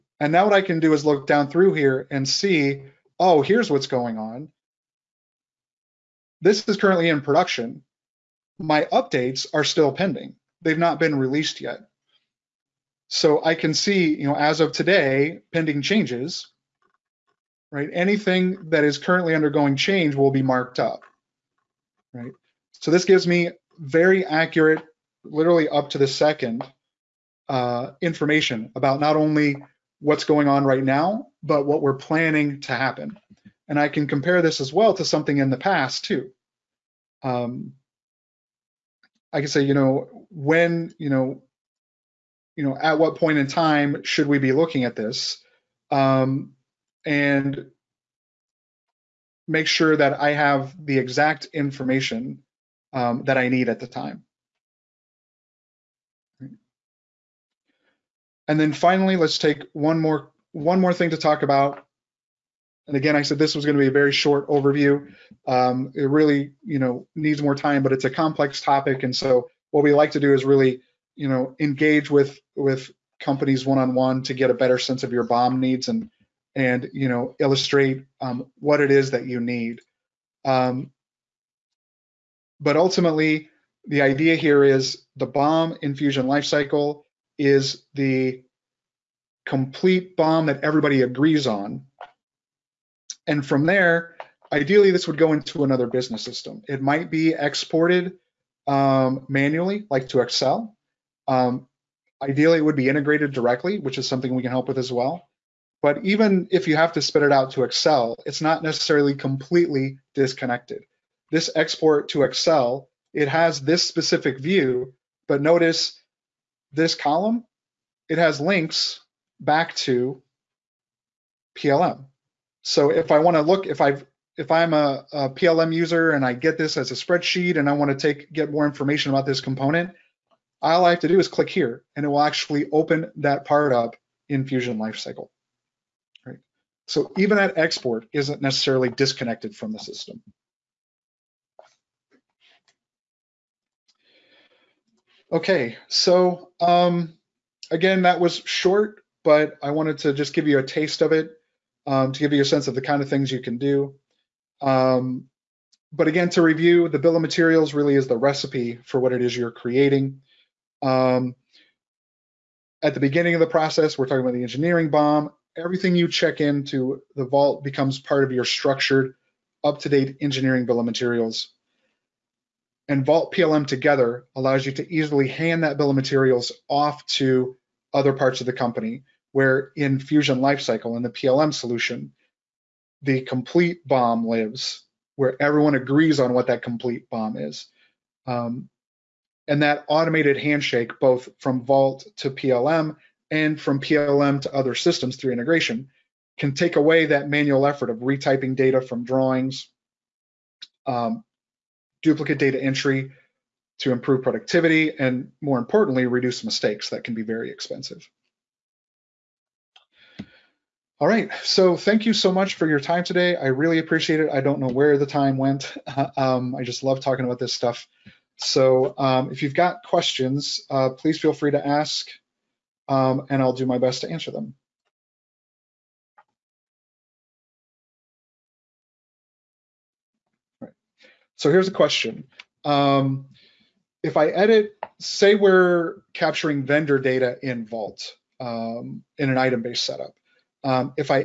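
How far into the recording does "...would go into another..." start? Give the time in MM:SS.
01:35.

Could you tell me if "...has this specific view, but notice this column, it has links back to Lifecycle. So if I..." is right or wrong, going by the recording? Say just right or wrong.
wrong.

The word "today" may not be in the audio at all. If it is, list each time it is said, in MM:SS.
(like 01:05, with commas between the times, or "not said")
00:14, 03:33.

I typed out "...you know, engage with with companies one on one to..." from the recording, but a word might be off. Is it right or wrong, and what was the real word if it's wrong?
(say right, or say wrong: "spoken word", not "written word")
right.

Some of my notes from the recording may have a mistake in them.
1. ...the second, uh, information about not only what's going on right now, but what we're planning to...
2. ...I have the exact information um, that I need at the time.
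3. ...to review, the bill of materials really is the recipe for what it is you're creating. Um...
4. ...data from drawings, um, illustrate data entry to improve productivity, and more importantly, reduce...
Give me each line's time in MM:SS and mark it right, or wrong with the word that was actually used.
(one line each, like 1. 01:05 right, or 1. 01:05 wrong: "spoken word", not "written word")
1. 00:25 right
2. 00:50 right
3. 02:36 right
4. 03:18 wrong: "duplicate", not "illustrate".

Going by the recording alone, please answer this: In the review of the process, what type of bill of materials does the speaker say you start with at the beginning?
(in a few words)
engineering BOM.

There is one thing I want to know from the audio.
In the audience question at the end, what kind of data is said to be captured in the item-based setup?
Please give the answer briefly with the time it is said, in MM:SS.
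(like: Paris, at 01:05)
vendor data, at 03:56.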